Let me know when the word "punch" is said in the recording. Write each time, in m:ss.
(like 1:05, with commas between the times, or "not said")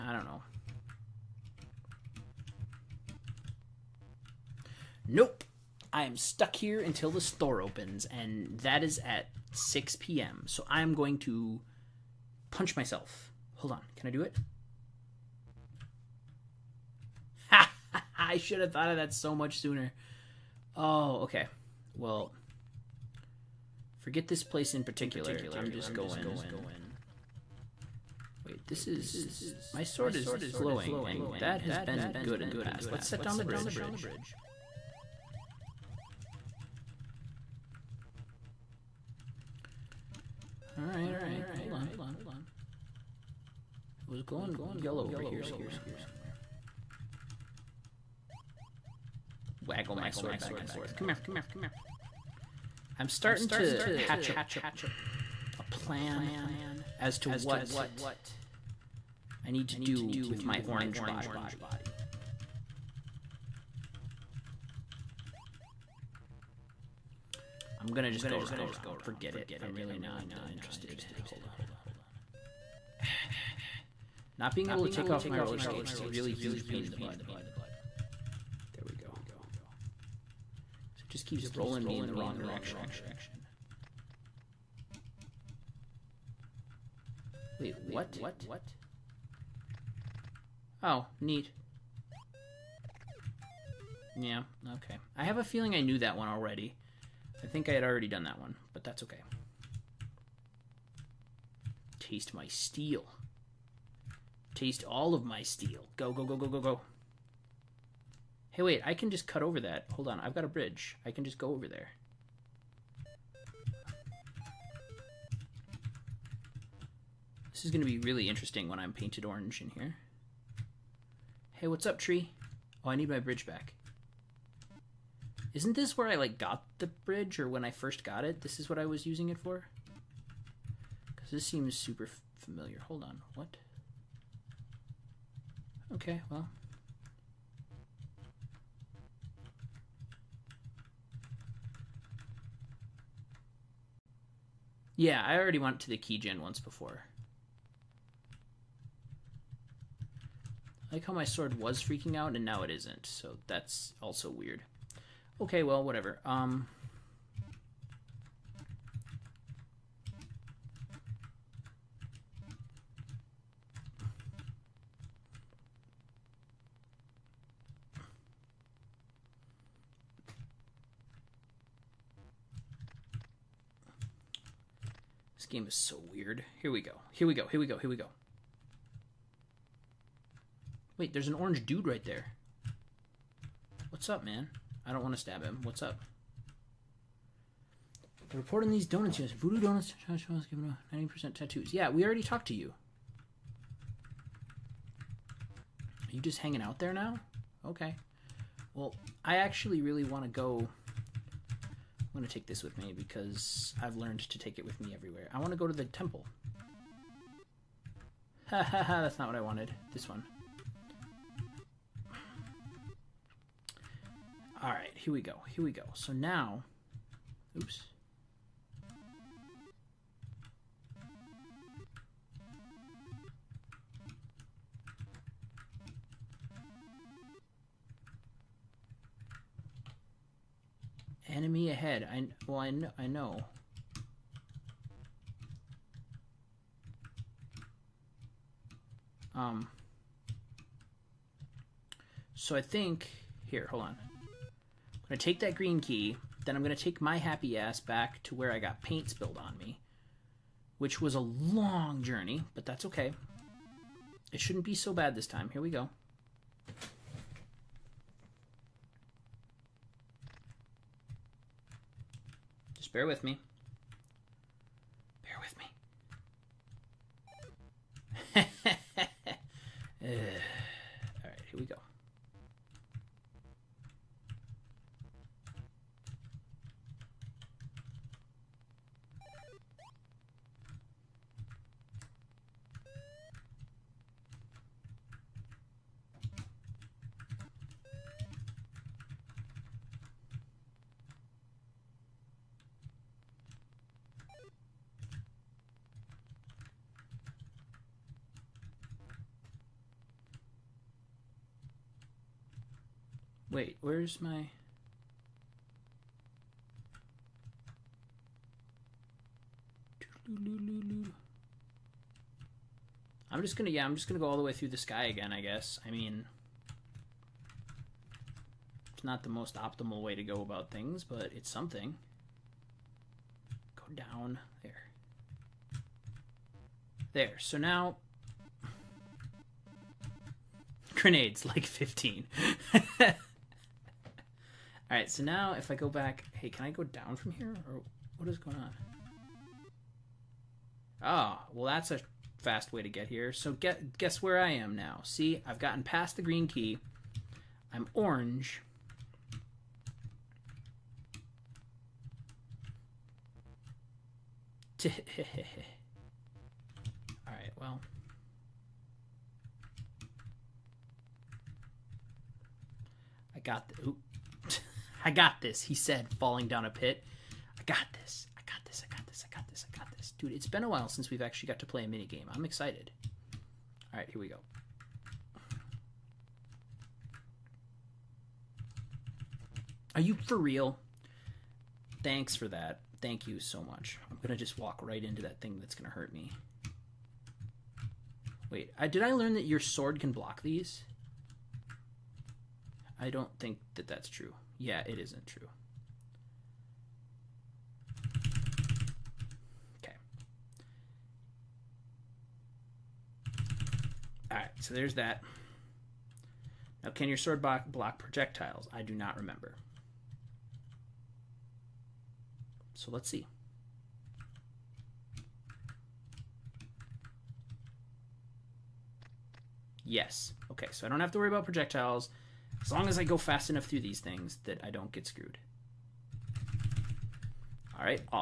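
0:12.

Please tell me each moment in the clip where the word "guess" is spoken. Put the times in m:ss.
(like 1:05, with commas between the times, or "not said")
5:15, 5:43.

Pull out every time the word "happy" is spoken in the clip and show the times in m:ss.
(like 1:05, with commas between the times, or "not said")
4:07.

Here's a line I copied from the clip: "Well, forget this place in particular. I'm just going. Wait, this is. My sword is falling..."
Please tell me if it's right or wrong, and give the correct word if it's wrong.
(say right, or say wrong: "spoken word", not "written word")
wrong: "glowing", not "falling".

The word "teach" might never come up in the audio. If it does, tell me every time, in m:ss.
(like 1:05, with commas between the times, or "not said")
not said.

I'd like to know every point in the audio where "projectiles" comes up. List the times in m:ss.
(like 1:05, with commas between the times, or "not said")
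6:47, 7:01.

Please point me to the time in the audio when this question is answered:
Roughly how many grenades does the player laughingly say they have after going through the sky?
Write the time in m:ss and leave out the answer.
5:31.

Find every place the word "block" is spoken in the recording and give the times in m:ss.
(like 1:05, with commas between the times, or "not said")
6:30, 6:47.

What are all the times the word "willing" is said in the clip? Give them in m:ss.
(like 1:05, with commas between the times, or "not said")
not said.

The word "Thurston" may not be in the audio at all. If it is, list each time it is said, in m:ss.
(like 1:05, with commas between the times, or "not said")
not said.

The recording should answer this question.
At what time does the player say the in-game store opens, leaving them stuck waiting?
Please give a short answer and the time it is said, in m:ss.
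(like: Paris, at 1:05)
6 p.m., at 0:09.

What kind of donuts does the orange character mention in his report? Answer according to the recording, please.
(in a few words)
Voodoo donuts.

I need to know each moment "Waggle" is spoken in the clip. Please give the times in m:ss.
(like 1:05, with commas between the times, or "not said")
0:49.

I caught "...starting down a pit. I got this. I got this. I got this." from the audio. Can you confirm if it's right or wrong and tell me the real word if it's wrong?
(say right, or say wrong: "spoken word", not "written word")
wrong: "falling", not "starting".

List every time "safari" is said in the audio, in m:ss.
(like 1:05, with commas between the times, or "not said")
not said.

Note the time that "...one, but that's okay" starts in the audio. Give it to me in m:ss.
1:38.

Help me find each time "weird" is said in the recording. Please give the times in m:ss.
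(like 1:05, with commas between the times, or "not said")
2:34, 2:56.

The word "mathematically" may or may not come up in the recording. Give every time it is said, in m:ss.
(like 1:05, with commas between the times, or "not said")
not said.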